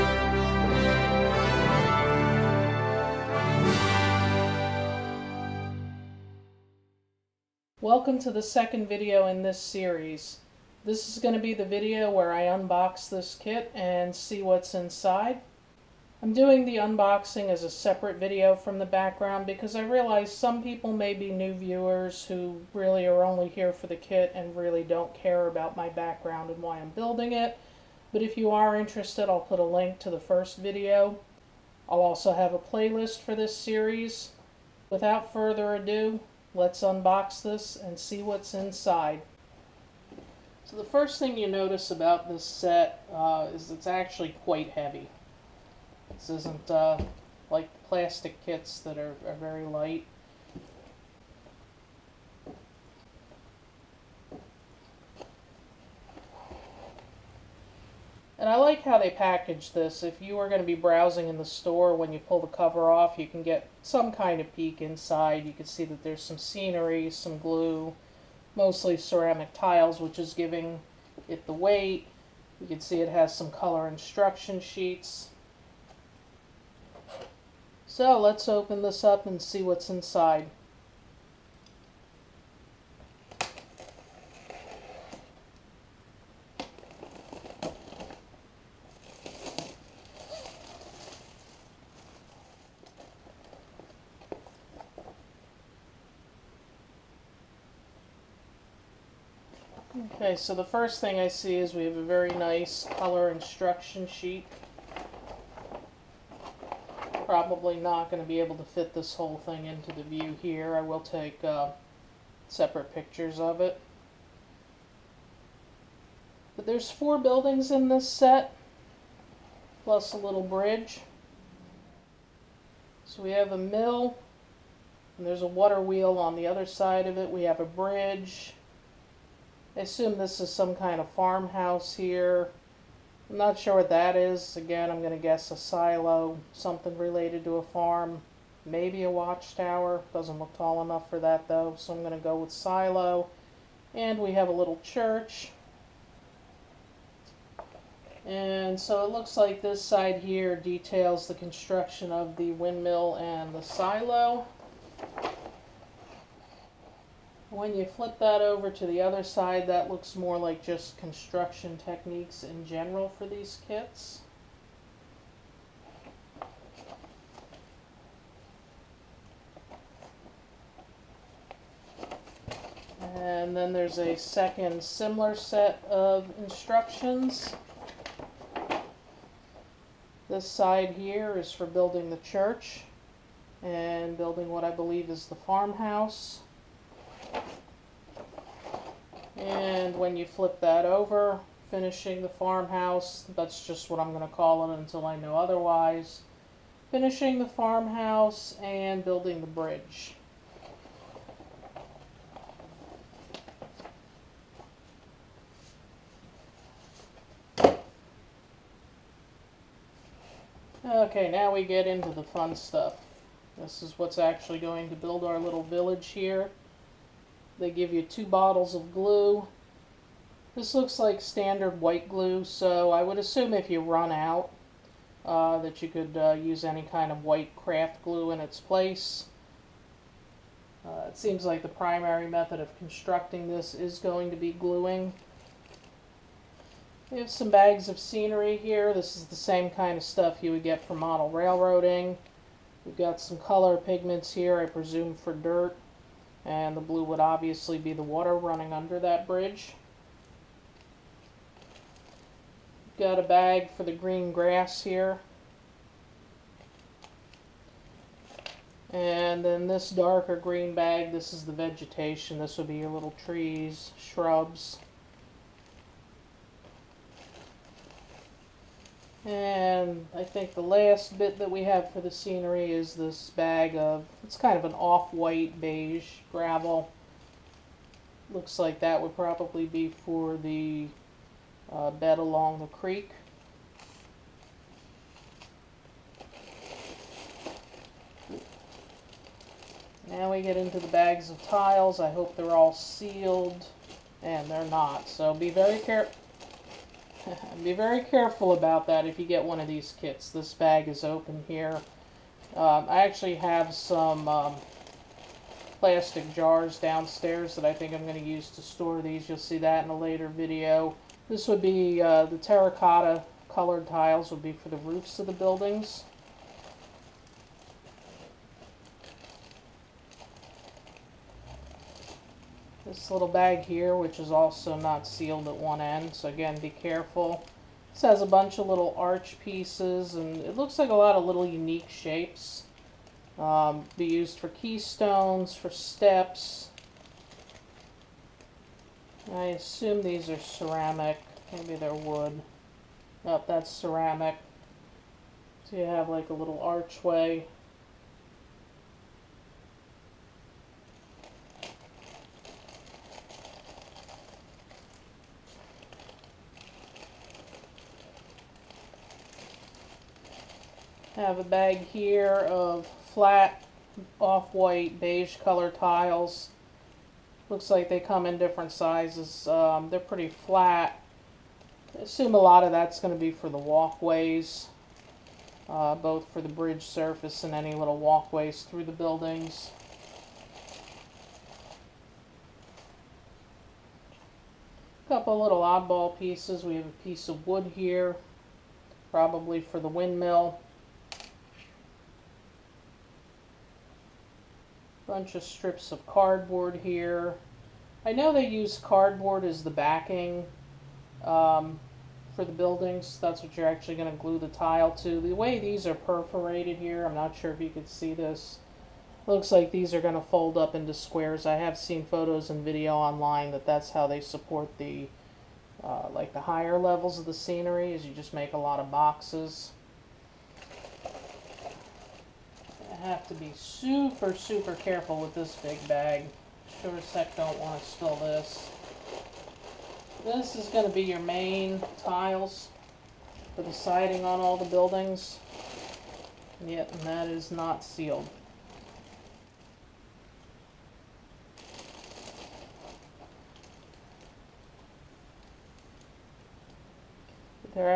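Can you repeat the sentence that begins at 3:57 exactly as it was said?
We have some bags of scenery here.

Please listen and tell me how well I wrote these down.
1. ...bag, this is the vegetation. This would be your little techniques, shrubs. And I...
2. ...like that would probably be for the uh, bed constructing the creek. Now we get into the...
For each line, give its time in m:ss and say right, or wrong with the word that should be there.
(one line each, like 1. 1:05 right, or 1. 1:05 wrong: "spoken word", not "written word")
1. 4:20 wrong: "trees", not "techniques"
2. 4:38 wrong: "along", not "constructing".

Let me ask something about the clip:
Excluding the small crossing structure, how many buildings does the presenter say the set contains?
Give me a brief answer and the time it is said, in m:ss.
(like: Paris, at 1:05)
4, at 1:56.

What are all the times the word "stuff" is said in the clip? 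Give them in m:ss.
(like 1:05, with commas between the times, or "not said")
3:32, 4:00.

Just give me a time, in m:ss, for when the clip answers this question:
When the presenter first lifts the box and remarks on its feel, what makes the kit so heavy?
1:08.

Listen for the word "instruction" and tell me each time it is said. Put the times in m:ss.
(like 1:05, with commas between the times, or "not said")
1:13, 1:43, 2:56.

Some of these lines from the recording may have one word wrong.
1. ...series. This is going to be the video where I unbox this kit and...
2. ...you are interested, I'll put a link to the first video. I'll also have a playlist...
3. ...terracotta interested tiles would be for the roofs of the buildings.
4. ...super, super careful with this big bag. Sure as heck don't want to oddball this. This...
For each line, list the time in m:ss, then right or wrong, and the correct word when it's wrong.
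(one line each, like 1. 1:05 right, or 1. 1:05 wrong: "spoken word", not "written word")
1. 0:09 right
2. 0:28 right
3. 5:12 wrong: "colored", not "interested"
4. 7:03 wrong: "spill", not "oddball".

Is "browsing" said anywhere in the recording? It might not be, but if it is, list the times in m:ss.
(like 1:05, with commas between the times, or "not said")
1:00.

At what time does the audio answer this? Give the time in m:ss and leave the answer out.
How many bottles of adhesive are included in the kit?
3:38.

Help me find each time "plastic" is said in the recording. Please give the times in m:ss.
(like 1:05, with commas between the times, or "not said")
0:47, 5:05.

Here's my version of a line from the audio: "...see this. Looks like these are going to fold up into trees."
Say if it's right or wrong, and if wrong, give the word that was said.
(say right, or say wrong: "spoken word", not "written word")
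wrong: "squares", not "trees".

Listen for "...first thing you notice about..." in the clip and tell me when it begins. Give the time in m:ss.
0:40.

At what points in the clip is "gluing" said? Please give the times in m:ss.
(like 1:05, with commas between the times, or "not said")
3:54.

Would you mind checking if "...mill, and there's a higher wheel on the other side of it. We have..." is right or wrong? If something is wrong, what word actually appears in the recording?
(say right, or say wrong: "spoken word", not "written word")
wrong: "water", not "higher".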